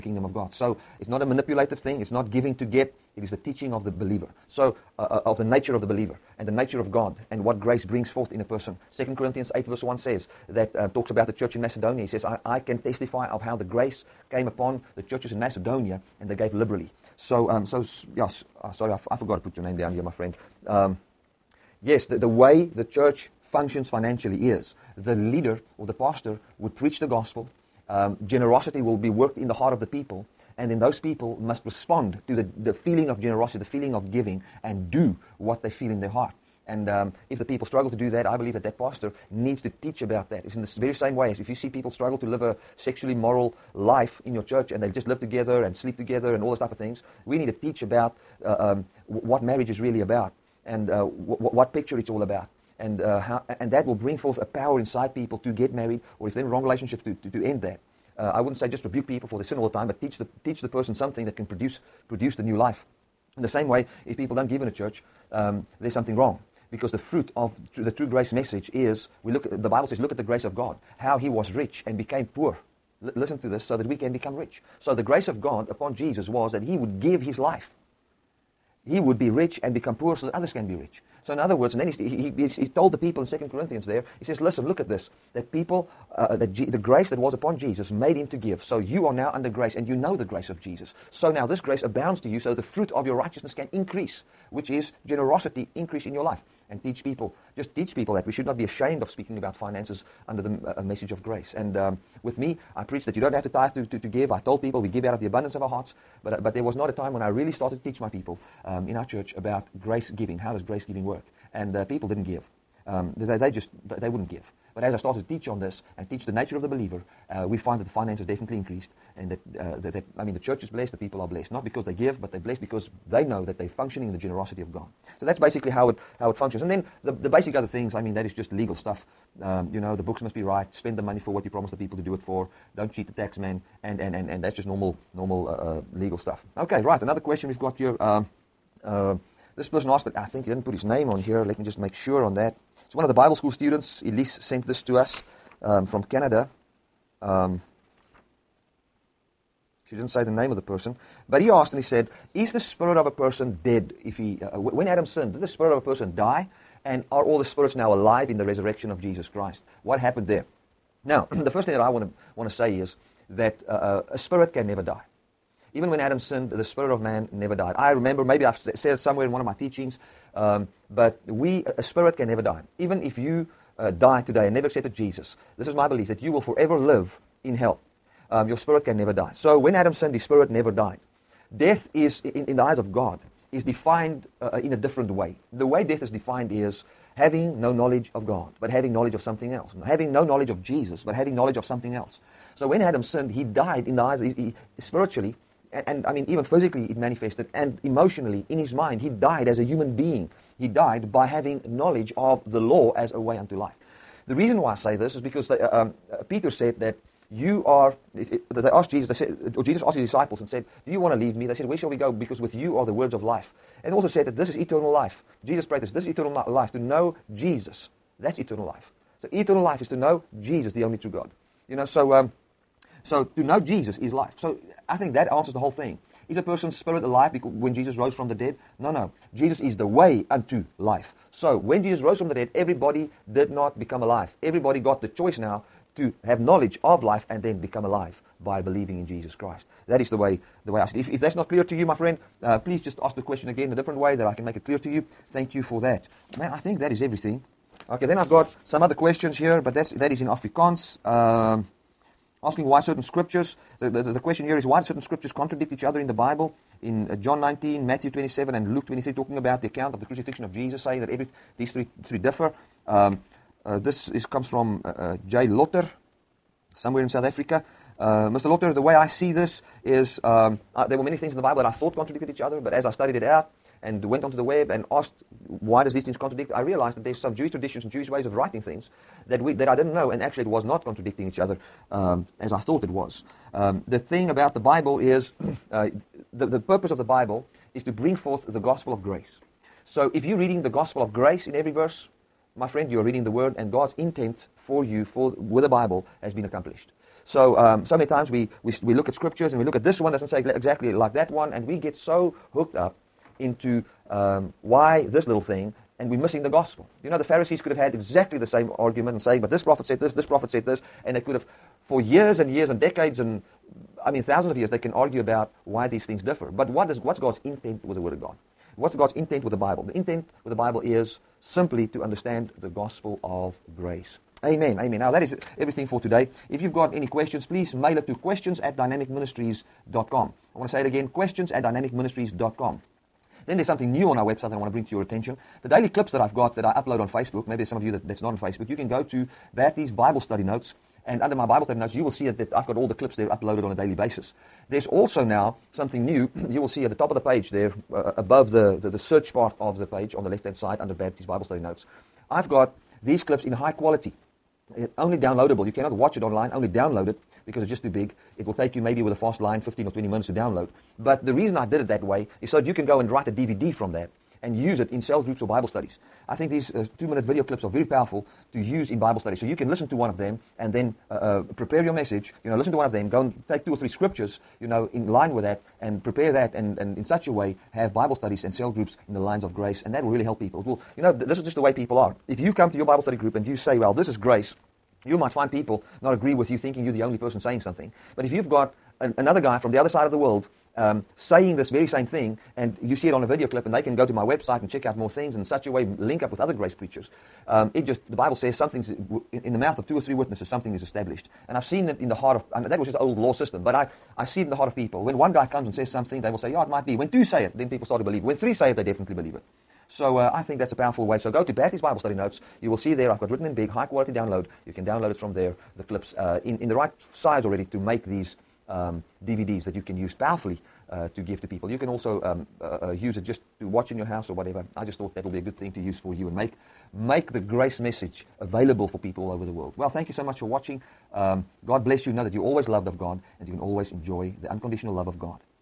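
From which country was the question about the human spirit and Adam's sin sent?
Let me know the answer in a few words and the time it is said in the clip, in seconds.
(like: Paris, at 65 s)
Canada, at 146 s.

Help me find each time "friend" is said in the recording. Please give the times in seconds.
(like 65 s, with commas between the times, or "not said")
20 s, 241 s, 292 s.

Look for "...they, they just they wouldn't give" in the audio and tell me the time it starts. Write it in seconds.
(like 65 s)
113 s.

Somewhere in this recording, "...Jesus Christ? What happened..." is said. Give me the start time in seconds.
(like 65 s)
159 s.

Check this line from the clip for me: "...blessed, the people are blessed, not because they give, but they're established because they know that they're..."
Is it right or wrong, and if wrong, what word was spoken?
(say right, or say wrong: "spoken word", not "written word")
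wrong: "blessed", not "established".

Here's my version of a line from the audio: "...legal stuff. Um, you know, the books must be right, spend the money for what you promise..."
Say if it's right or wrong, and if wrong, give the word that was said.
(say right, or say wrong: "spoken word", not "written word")
right.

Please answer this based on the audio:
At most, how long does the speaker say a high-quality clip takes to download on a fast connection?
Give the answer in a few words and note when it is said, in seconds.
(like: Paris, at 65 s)
20 minutes, at 359 s.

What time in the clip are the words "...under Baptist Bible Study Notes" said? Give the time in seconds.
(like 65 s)
350 s.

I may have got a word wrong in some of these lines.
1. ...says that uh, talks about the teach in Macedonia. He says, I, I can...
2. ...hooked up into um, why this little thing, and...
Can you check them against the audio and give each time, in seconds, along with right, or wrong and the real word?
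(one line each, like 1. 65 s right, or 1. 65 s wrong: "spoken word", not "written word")
1. 9 s wrong: "church", not "teach"
2. 302 s right.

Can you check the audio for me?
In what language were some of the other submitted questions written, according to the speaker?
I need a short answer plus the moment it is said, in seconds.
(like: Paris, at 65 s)
Afrikaans, at 250 s.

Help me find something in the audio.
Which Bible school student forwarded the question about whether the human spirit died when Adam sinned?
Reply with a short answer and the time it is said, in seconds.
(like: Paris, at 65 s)
Elise, at 144 s.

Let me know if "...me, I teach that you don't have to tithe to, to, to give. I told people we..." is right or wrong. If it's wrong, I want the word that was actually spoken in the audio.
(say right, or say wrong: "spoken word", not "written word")
wrong: "preach", not "teach".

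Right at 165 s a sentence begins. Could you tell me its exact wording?
Even when Adam sinned, the spirit of man never died.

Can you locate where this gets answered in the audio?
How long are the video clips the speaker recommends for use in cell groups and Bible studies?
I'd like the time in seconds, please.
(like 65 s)
366 s.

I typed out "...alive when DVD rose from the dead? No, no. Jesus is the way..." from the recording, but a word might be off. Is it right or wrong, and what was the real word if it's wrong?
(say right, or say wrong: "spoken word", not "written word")
wrong: "Jesus", not "DVD".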